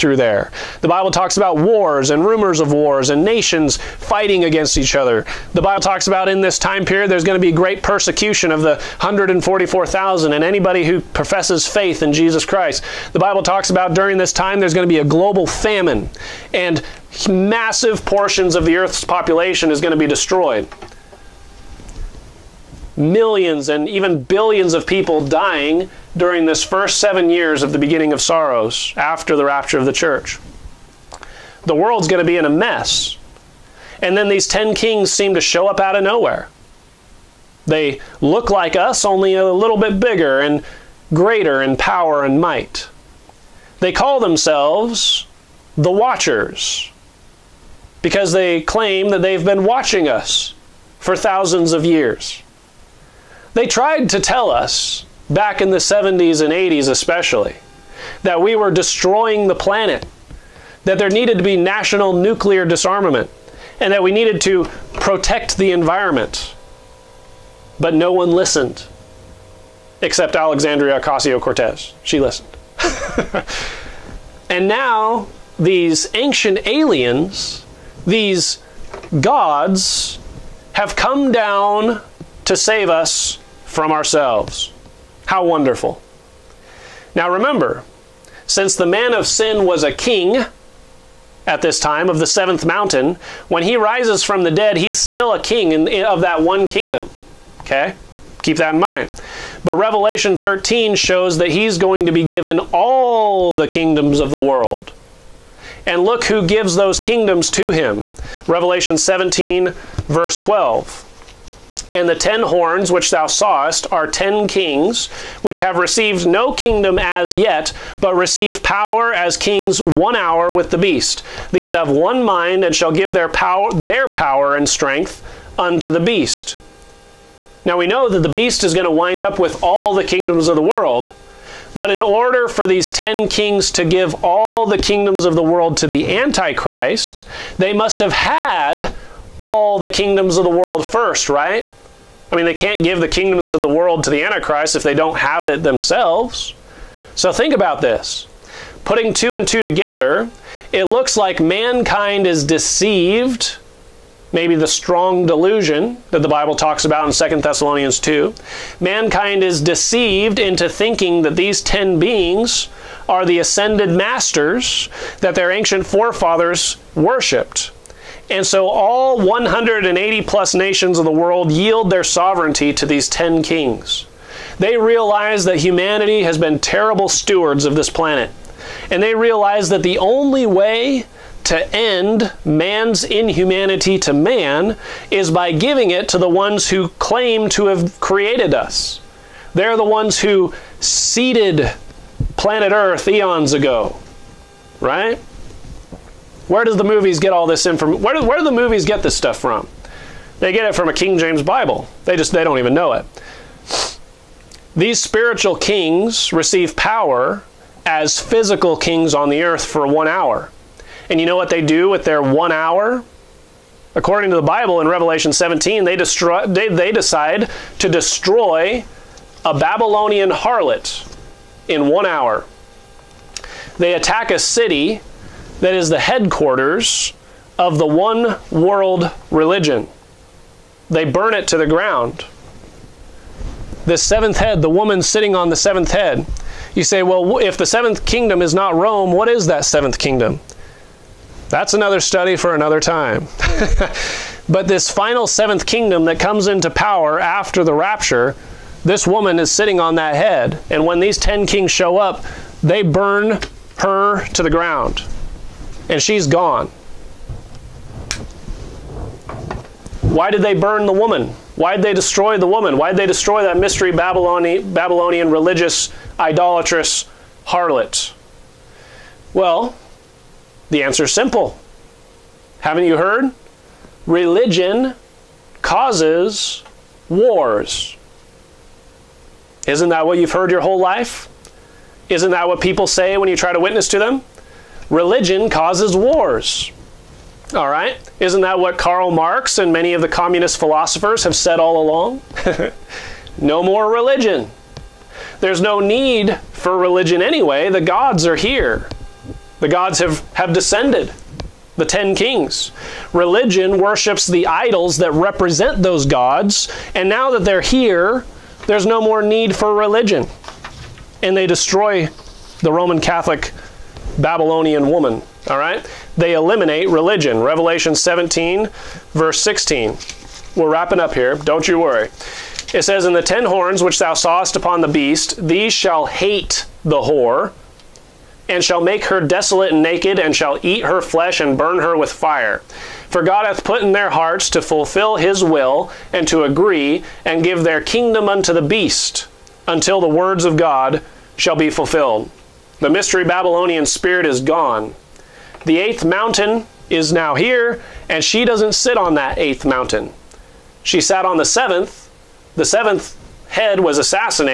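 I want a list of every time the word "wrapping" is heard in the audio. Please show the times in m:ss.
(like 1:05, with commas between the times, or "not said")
5:20.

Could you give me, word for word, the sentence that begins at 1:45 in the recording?
And look who gives those kingdoms to him.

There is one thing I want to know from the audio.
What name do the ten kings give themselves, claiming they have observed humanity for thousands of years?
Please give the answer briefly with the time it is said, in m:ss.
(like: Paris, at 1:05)
The Watchers, at 0:45.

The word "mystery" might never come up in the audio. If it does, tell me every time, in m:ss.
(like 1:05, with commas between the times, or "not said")
4:23, 5:42.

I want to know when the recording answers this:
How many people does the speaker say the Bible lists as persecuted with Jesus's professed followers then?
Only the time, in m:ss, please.
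0:08.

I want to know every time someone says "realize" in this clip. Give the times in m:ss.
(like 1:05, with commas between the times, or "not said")
2:54, 2:59.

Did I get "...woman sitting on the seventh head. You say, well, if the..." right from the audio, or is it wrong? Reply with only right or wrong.
right.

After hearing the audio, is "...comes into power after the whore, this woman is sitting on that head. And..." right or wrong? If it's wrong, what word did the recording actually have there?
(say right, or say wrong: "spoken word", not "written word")
wrong: "rapture", not "whore".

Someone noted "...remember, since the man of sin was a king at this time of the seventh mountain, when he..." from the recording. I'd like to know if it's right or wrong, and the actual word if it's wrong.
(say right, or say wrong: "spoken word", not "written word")
right.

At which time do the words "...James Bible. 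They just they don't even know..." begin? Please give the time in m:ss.
3:21.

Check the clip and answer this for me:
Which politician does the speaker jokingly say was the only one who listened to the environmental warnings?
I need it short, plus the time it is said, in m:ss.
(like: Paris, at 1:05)
Alexandria Ocasio Cortez, at 1:10.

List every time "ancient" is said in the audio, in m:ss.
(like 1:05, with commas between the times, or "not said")
1:16, 2:45.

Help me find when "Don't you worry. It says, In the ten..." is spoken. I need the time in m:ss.
5:21.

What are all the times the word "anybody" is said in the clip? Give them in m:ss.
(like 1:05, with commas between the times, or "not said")
0:10.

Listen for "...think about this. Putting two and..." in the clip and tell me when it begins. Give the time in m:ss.
2:27.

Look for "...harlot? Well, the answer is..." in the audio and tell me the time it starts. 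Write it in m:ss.
4:27.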